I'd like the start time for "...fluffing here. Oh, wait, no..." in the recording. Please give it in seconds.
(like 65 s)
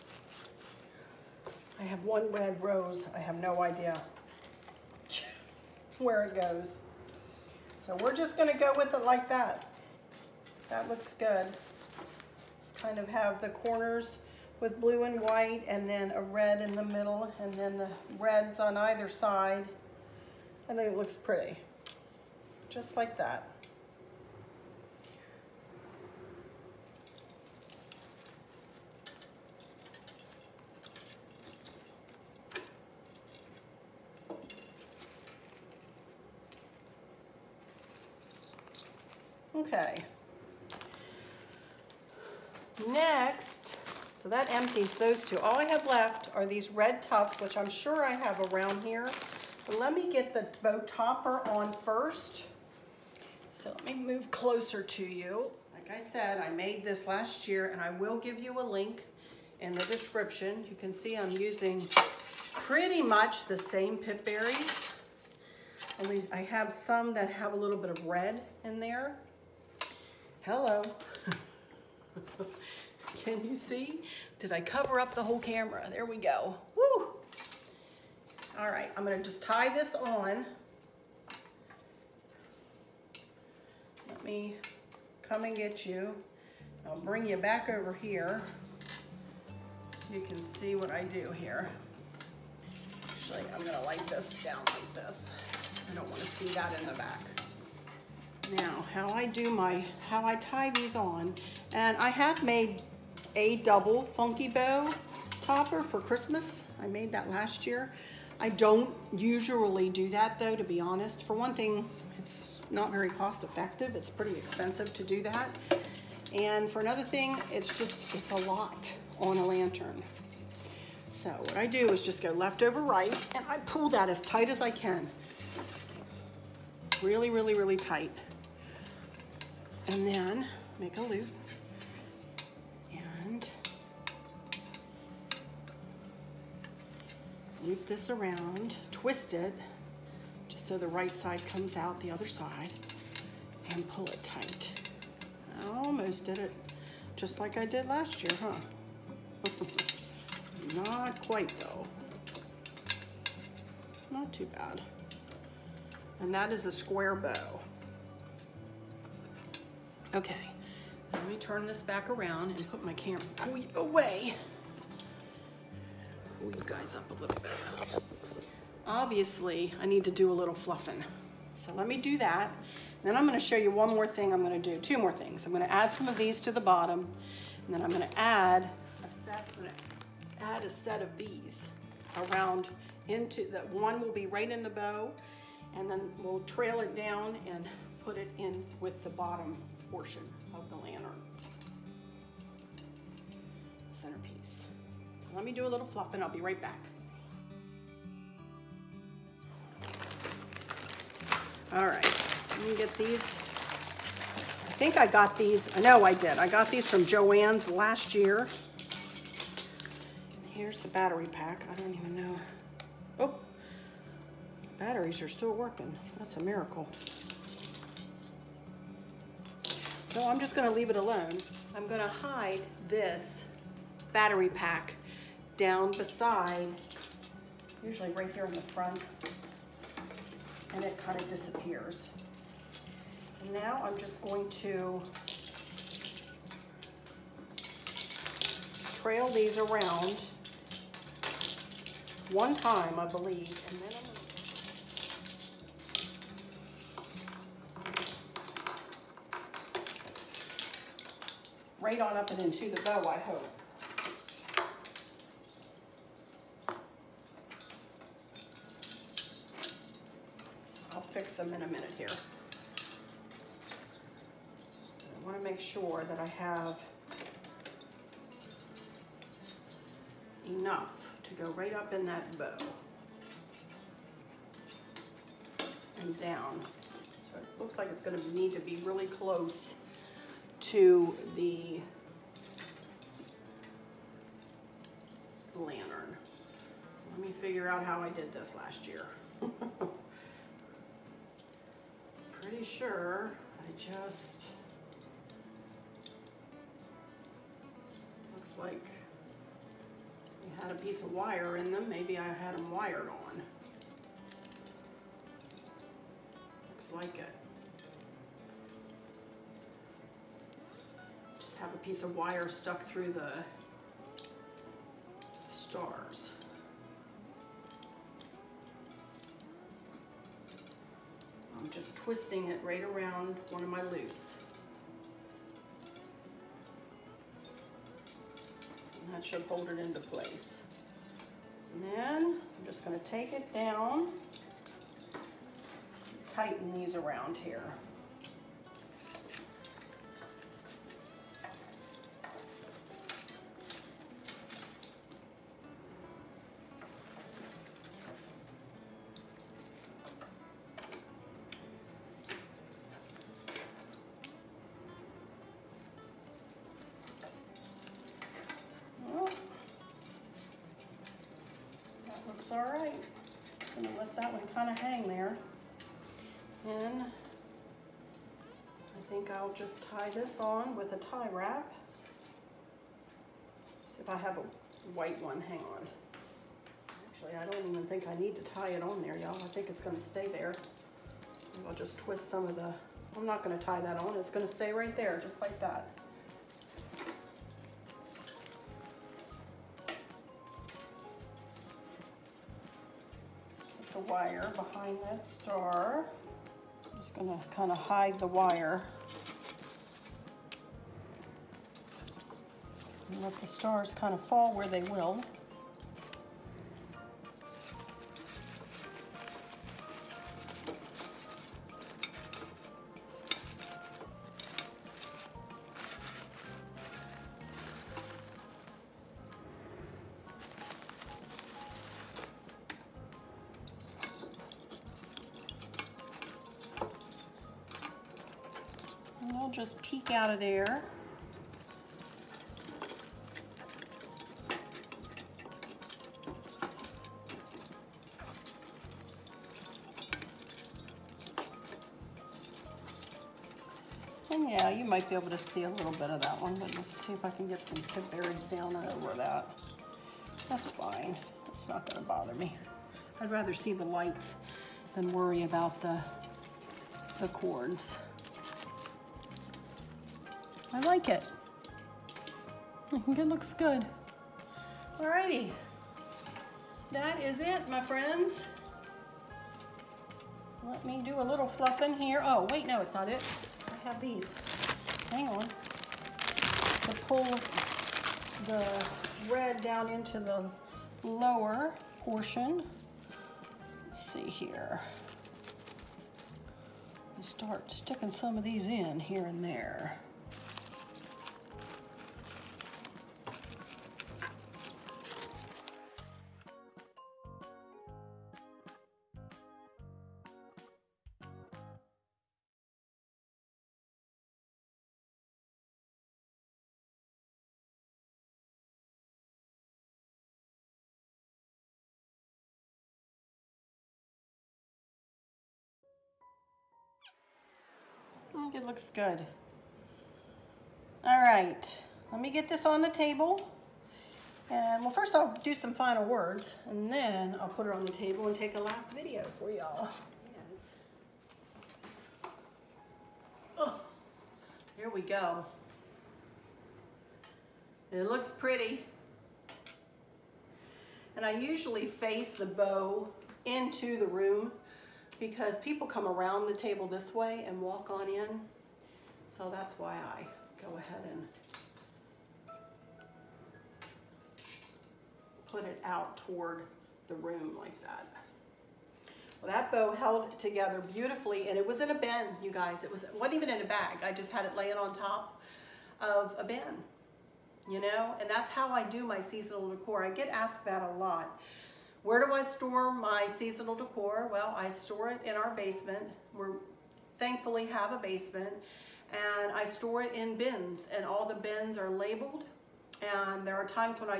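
471 s.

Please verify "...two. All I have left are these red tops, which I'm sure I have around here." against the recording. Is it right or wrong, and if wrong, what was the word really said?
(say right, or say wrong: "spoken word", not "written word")
right.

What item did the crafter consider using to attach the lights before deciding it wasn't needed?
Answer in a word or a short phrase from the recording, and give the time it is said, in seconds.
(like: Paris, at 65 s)
tie wrap, at 370 s.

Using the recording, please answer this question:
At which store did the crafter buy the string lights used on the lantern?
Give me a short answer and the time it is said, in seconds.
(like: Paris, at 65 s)
Joann's, at 207 s.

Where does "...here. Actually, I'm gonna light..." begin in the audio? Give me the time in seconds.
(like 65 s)
91 s.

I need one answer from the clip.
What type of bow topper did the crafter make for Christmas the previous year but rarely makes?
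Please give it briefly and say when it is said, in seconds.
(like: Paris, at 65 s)
double funky bow topper, at 103 s.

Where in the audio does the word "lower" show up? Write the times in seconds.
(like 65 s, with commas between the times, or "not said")
481 s.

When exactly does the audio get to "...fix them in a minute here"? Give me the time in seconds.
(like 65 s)
261 s.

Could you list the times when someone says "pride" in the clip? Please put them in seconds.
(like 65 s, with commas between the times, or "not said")
not said.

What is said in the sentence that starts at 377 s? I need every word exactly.
Actually, I don't even think I need to tie it on there, y'all.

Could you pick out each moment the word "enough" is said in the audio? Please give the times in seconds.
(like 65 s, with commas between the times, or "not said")
270 s.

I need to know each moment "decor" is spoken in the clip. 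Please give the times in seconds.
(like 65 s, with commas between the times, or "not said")
569 s, 573 s.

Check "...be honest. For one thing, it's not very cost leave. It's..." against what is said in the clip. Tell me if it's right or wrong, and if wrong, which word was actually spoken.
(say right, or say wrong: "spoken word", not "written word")
wrong: "effective", not "leave".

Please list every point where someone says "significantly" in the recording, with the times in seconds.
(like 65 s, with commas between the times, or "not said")
not said.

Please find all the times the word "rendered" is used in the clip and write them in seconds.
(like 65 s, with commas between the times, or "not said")
not said.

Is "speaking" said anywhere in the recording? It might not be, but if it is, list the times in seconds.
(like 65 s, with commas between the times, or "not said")
not said.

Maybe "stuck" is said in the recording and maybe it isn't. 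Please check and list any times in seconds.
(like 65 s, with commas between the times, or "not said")
312 s.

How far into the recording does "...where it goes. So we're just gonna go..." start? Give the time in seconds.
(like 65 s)
5 s.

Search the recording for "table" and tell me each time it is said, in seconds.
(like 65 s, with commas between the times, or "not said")
522 s, 527 s, 546 s.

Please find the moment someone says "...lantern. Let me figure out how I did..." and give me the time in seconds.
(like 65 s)
285 s.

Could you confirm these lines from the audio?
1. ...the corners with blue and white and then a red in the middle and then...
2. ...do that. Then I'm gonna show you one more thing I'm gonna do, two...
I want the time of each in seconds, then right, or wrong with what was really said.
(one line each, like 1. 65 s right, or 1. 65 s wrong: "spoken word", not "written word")
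1. 13 s right
2. 171 s right.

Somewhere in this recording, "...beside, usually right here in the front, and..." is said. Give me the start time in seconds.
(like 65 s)
225 s.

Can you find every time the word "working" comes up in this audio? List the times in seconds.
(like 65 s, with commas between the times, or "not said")
215 s.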